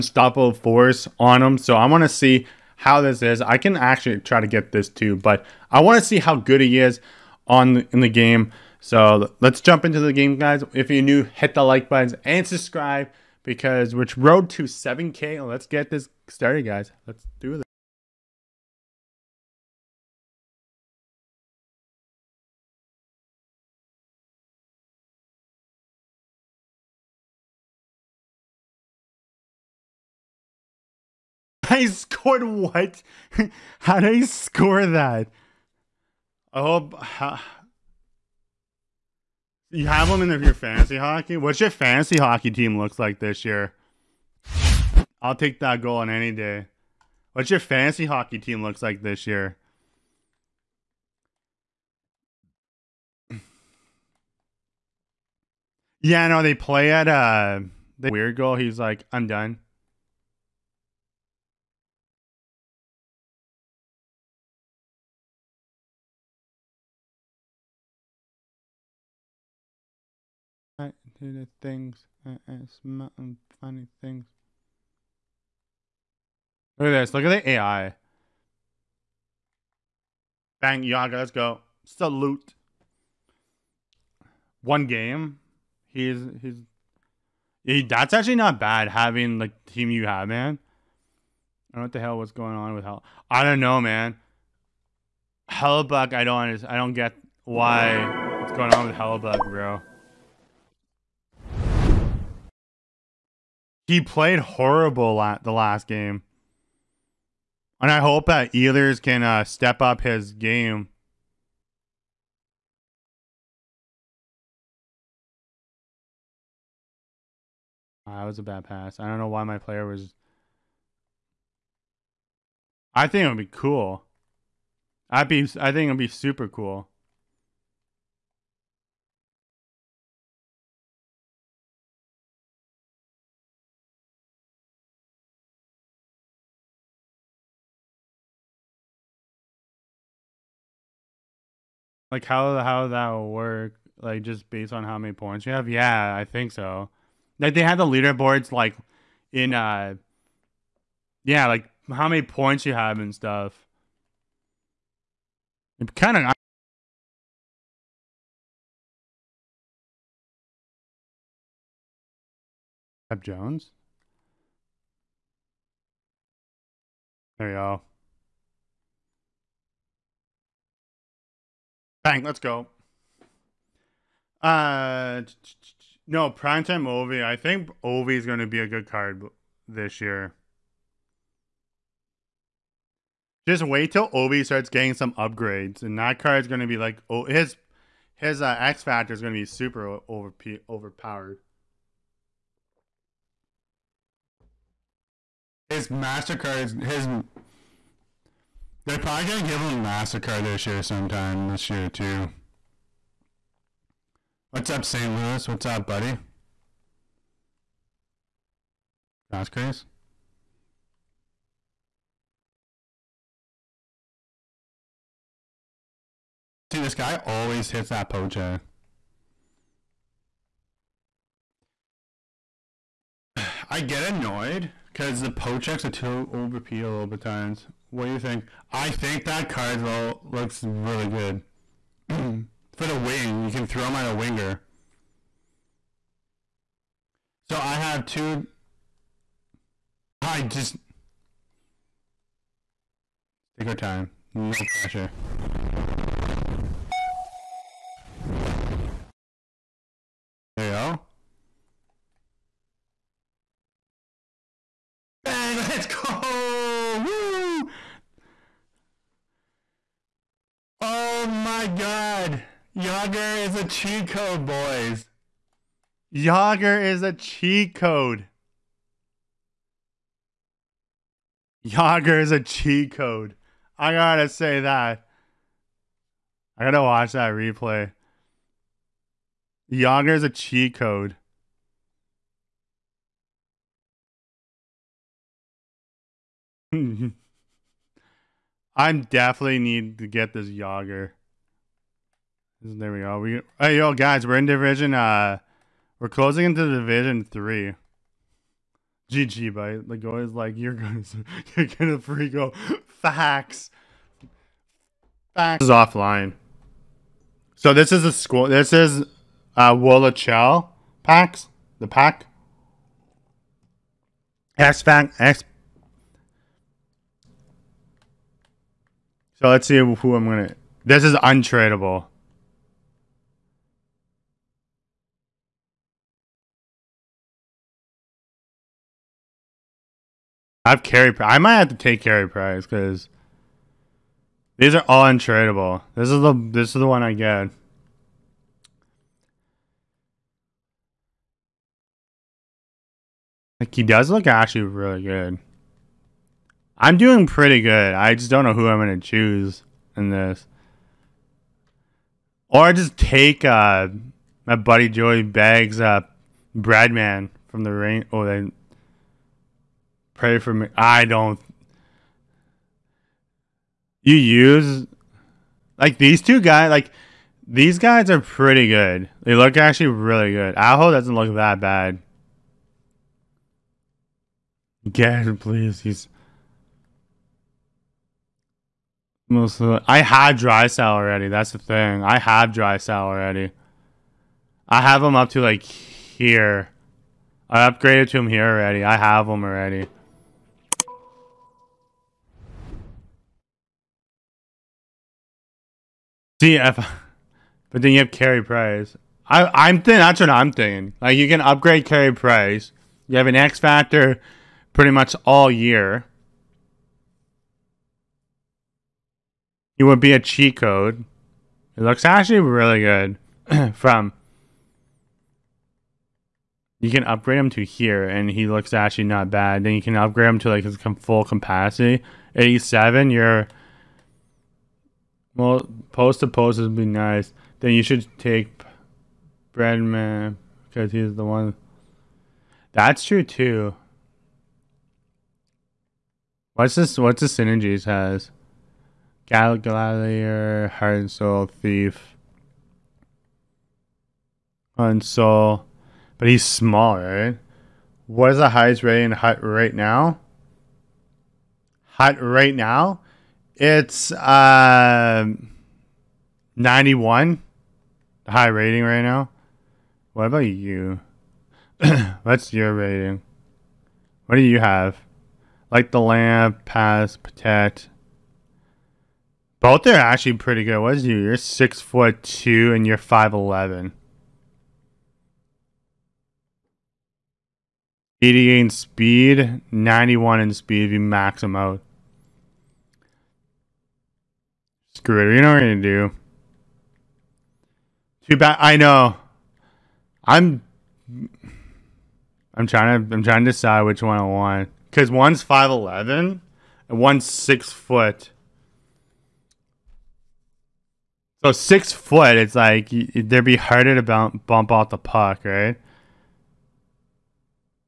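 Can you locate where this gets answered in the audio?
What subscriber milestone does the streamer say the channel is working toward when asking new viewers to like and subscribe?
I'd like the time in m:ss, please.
0:14.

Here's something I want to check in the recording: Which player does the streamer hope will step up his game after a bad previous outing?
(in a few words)
Ehlers.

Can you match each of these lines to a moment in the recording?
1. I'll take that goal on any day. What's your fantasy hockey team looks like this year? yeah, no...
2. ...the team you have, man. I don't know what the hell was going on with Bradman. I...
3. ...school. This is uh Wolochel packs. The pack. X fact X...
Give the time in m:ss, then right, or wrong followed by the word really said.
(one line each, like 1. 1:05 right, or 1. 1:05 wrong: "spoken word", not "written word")
1. 0:45 right
2. 1:29 wrong: "Hell", not "Bradman"
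3. 5:08 right.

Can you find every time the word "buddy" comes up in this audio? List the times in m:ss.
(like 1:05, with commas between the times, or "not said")
3:25, 5:54.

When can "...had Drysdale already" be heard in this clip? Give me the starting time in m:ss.
6:20.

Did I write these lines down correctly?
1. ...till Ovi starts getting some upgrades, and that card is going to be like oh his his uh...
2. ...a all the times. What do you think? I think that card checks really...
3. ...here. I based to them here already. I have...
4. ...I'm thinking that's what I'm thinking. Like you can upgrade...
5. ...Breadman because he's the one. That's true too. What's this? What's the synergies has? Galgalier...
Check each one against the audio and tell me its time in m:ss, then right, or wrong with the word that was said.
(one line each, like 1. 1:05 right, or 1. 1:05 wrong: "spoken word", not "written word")
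1. 3:03 right
2. 3:46 wrong: "looks", not "checks"
3. 6:25 wrong: "upgraded", not "based"
4. 6:39 right
5. 7:09 right.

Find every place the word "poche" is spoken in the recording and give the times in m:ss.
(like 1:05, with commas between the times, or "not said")
3:38.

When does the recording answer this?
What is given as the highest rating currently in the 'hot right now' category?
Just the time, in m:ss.
7:36.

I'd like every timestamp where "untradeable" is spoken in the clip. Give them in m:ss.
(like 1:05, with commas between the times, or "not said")
5:21, 5:35.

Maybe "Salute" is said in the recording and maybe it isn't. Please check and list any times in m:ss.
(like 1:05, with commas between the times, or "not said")
1:21.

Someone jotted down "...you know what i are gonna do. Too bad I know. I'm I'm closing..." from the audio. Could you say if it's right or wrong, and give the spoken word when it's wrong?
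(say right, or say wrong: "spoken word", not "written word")
wrong: "trying", not "closing".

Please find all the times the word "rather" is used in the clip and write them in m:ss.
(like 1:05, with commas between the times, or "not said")
not said.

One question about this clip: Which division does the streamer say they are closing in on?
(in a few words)
division three.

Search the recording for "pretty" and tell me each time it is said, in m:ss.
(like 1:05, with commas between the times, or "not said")
5:47, 6:08, 6:44, 7:50.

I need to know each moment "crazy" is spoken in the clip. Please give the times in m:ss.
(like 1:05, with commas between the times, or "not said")
3:29.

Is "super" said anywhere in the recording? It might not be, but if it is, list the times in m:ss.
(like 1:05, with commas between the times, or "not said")
2:06, 3:09.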